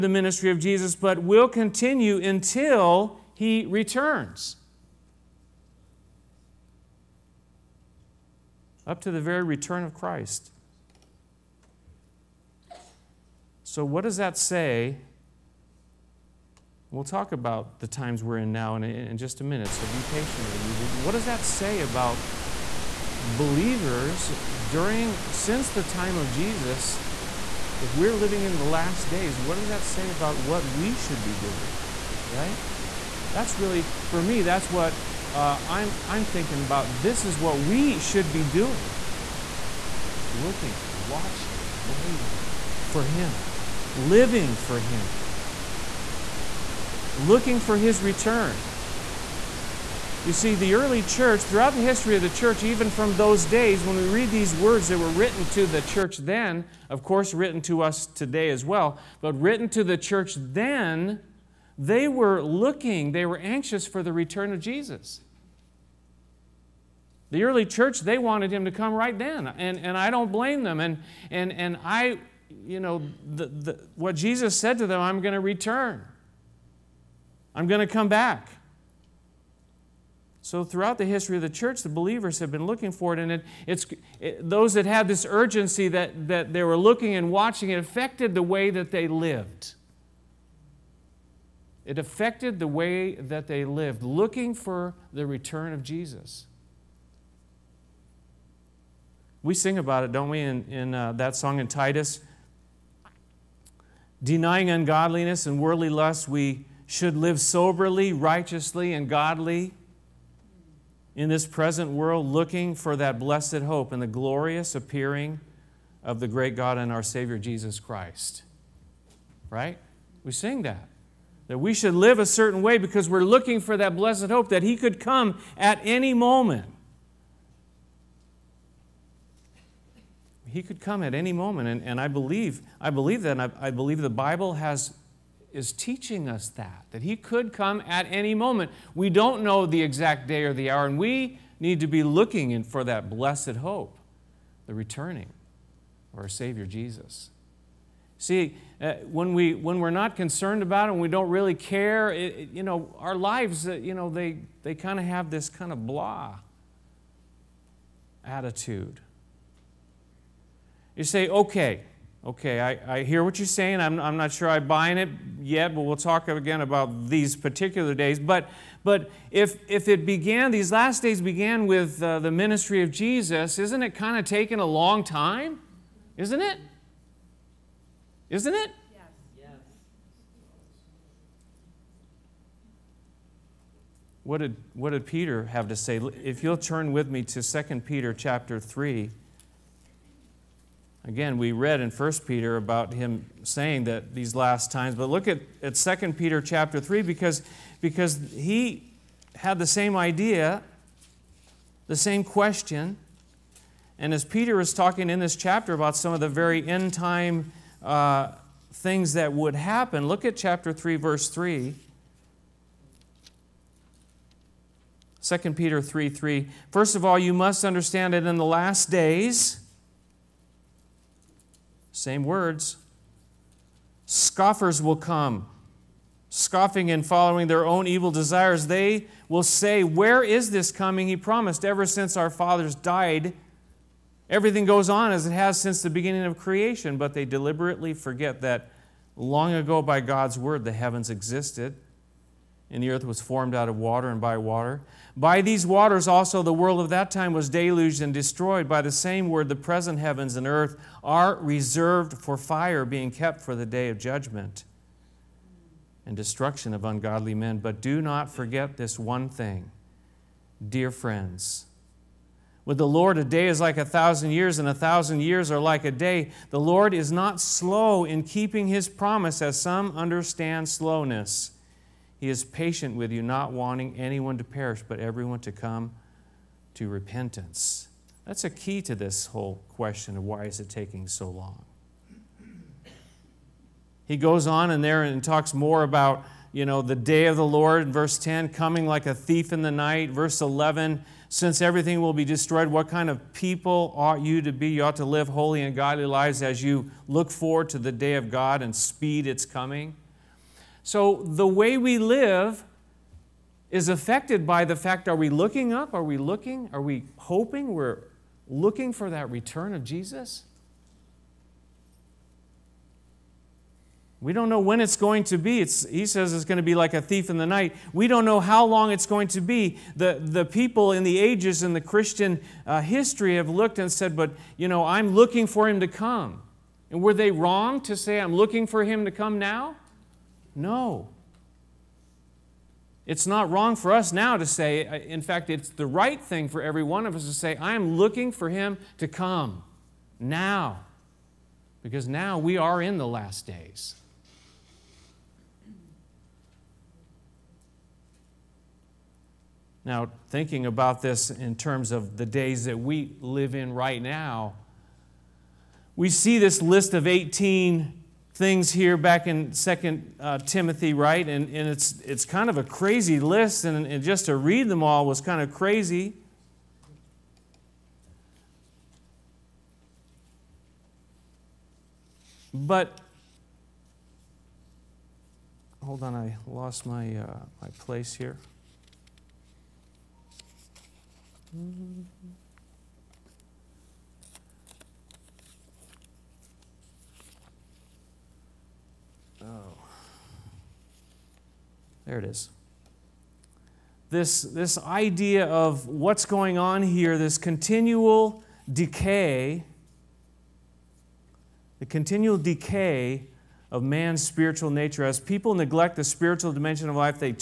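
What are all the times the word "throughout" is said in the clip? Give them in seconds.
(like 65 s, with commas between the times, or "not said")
51 s, 80 s.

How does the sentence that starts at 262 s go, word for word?
With the Lord, a day is like a thousand years, and a thousand years are like a day.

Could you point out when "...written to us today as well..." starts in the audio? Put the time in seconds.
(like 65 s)
57 s.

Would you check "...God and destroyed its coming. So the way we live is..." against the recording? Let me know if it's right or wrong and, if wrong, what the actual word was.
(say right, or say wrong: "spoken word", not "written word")
wrong: "speed", not "destroyed".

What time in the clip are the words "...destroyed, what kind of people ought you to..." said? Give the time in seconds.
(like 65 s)
292 s.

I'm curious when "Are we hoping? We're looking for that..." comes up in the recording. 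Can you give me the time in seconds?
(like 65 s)
306 s.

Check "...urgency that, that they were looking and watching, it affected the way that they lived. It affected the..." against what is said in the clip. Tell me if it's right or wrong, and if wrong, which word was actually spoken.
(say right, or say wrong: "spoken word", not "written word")
right.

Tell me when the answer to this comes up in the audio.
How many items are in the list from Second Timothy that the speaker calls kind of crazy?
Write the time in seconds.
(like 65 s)
357 s.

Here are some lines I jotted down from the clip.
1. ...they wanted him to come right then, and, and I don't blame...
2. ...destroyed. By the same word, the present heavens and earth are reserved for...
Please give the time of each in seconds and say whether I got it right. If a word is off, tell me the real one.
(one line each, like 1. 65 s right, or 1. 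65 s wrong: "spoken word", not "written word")
1. 68 s right
2. 248 s right.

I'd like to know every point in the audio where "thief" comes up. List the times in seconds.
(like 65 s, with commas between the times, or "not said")
289 s, 317 s.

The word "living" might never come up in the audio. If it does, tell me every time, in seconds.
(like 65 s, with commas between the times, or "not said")
28 s, 43 s.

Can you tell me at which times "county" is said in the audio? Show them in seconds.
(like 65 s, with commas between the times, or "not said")
not said.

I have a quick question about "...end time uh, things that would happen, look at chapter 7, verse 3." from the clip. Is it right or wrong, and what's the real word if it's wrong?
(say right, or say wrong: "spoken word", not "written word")
wrong: "3", not "7".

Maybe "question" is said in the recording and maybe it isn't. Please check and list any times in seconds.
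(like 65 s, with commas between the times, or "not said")
202 s, 279 s.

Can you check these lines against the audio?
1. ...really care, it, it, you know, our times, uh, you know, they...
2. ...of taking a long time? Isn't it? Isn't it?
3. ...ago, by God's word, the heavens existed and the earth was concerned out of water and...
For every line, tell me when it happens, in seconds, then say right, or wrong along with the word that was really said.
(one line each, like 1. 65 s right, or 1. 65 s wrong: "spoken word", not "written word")
1. 151 s wrong: "lives", not "times"
2. 174 s right
3. 239 s wrong: "formed", not "concerned".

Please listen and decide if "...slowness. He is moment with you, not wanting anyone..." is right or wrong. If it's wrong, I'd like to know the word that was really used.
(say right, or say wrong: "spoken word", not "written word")
wrong: "patient", not "moment".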